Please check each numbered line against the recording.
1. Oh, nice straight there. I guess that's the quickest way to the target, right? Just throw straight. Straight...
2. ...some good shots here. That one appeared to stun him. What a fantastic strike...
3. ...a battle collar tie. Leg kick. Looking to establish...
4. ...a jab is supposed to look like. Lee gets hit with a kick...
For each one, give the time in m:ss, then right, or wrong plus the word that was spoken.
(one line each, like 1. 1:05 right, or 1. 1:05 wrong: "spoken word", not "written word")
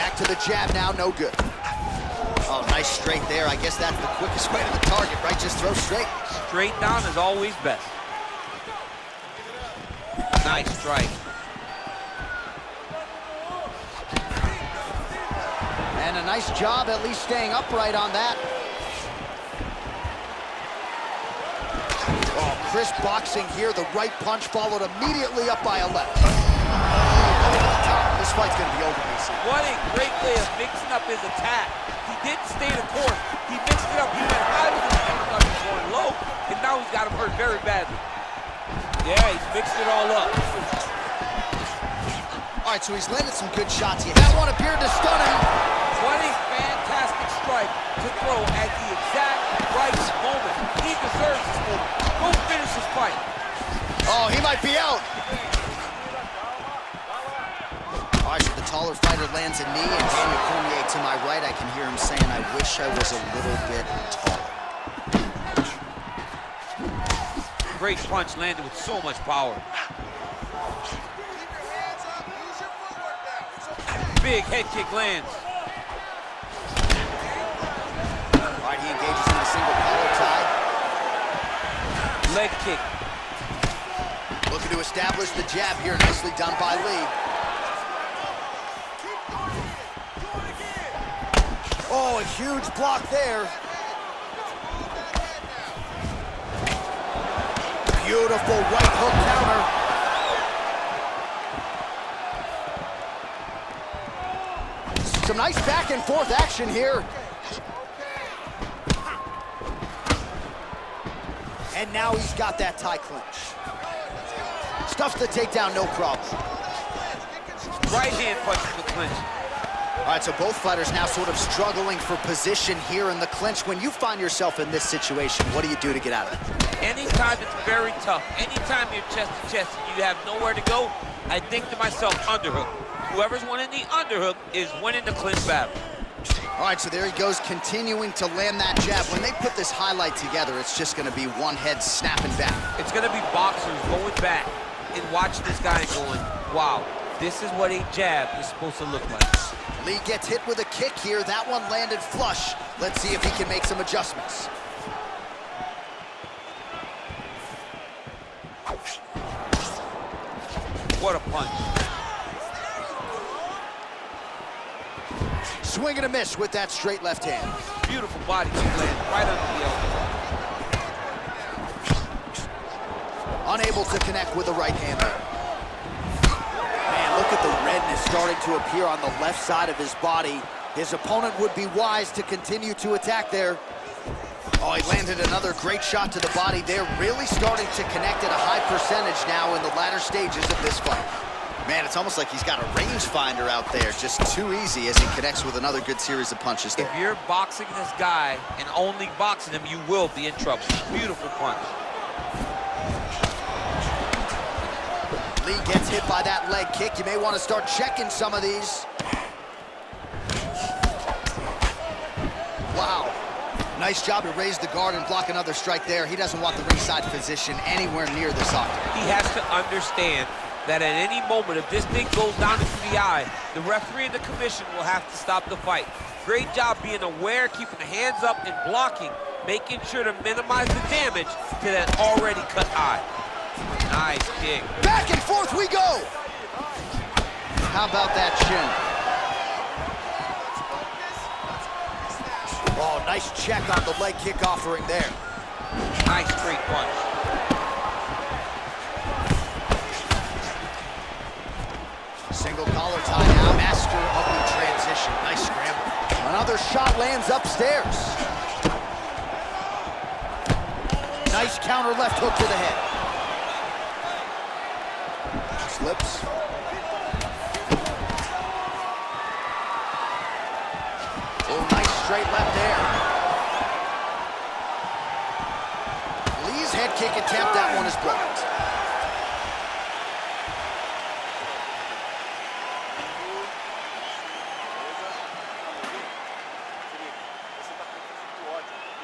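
1. 0:02 right
2. 0:43 right
3. 1:19 wrong: "single", not "battle"
4. 2:27 right.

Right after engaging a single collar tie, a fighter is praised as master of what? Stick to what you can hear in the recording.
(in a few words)
The transition.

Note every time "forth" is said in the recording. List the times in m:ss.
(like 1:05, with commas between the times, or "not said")
1:46, 3:55.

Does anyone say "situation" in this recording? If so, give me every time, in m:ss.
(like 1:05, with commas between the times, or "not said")
2:04.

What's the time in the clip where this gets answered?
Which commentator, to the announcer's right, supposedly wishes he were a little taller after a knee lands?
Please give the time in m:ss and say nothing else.
1:00.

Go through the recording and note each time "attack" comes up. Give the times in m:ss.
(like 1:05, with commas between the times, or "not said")
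0:31, 3:02.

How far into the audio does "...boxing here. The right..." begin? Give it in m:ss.
0:23.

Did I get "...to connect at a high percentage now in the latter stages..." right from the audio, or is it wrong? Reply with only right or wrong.
right.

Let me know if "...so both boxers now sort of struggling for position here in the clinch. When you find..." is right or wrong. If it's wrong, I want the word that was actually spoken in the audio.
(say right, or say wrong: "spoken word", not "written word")
wrong: "fighters", not "boxers".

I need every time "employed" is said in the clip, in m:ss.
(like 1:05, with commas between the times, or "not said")
not said.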